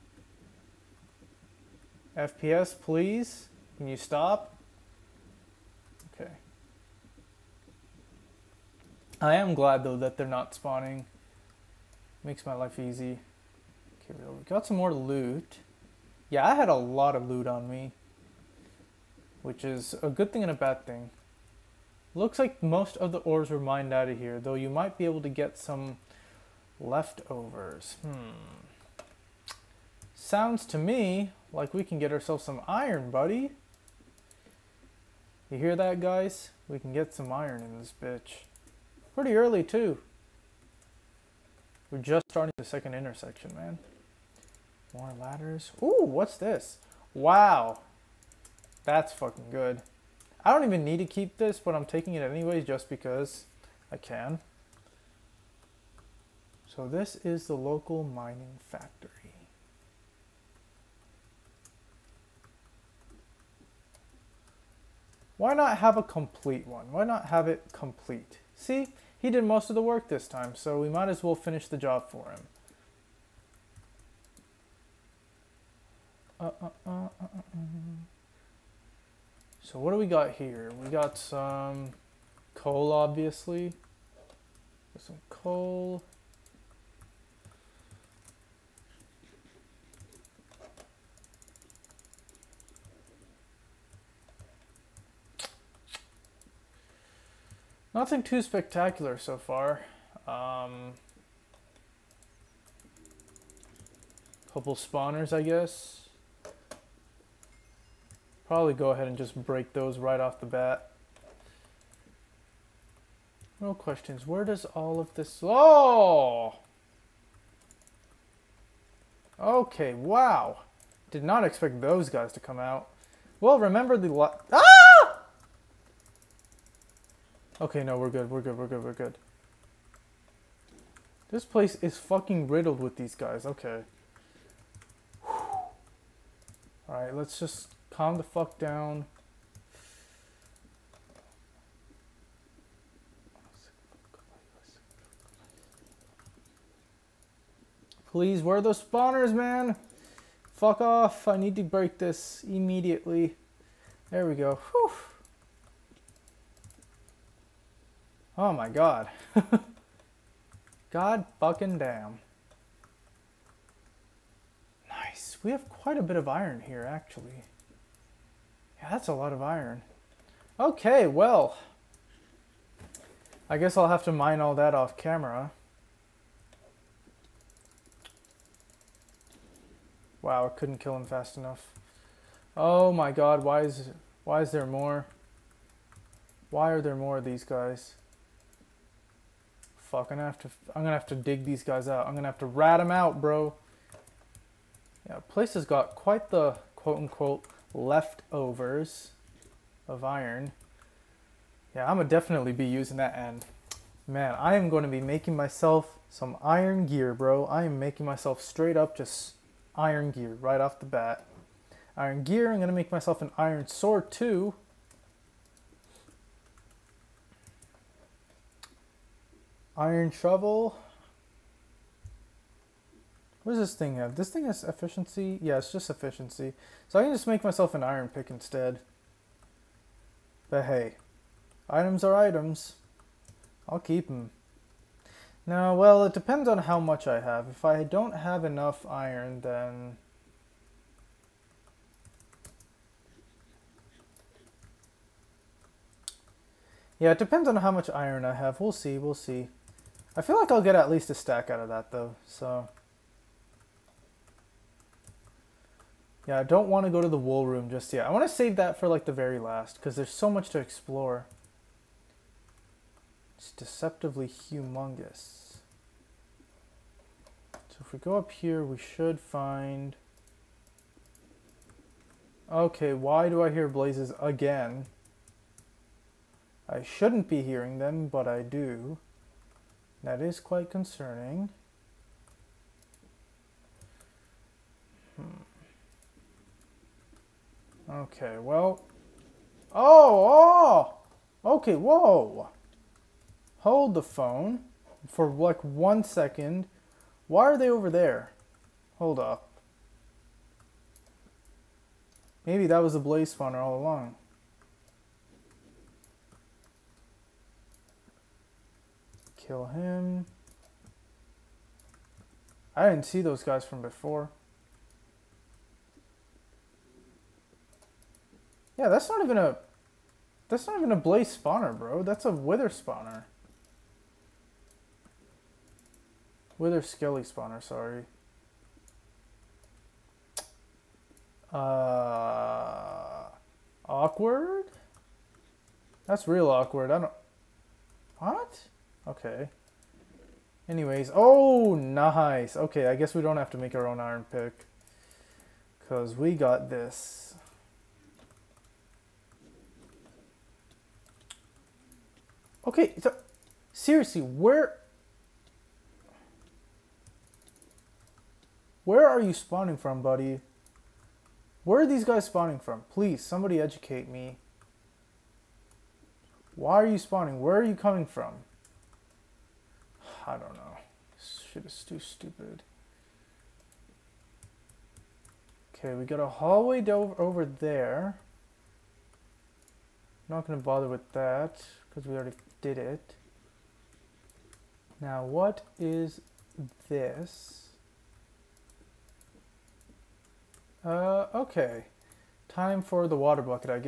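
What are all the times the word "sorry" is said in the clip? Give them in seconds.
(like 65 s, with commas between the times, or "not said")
327 s.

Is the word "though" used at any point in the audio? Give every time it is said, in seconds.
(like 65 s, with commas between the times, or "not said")
9 s, 24 s, 251 s.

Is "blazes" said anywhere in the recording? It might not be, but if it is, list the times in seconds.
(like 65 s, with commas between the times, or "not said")
273 s, 302 s, 320 s.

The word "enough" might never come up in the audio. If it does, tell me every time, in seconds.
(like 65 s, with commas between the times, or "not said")
181 s, 238 s.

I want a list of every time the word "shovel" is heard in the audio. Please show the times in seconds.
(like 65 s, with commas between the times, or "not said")
220 s.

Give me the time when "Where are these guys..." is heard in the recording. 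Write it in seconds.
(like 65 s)
361 s.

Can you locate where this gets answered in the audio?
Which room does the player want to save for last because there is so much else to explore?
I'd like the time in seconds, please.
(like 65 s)
257 s.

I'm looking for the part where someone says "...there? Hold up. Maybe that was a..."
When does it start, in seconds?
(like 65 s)
297 s.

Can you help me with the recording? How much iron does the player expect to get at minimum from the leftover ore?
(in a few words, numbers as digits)
a stack.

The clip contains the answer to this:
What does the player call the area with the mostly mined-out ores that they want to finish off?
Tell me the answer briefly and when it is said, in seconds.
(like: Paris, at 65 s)
local mining factory, at 57 s.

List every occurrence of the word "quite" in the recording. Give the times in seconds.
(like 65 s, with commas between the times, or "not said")
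165 s, 195 s, 280 s.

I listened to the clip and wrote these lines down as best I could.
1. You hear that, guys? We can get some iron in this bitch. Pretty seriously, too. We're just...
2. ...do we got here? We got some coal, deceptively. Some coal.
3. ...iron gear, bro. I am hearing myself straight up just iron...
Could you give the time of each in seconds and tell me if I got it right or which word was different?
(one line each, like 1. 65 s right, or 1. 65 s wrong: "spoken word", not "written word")
1. 35 s wrong: "early", not "seriously"
2. 79 s wrong: "obviously", not "deceptively"
3. 206 s wrong: "making", not "hearing".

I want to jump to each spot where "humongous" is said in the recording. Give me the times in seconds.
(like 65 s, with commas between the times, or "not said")
264 s.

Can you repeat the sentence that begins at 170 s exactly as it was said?
Okay, well, I guess I'll have to mine all that off camera.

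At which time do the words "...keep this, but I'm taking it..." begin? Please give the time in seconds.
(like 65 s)
51 s.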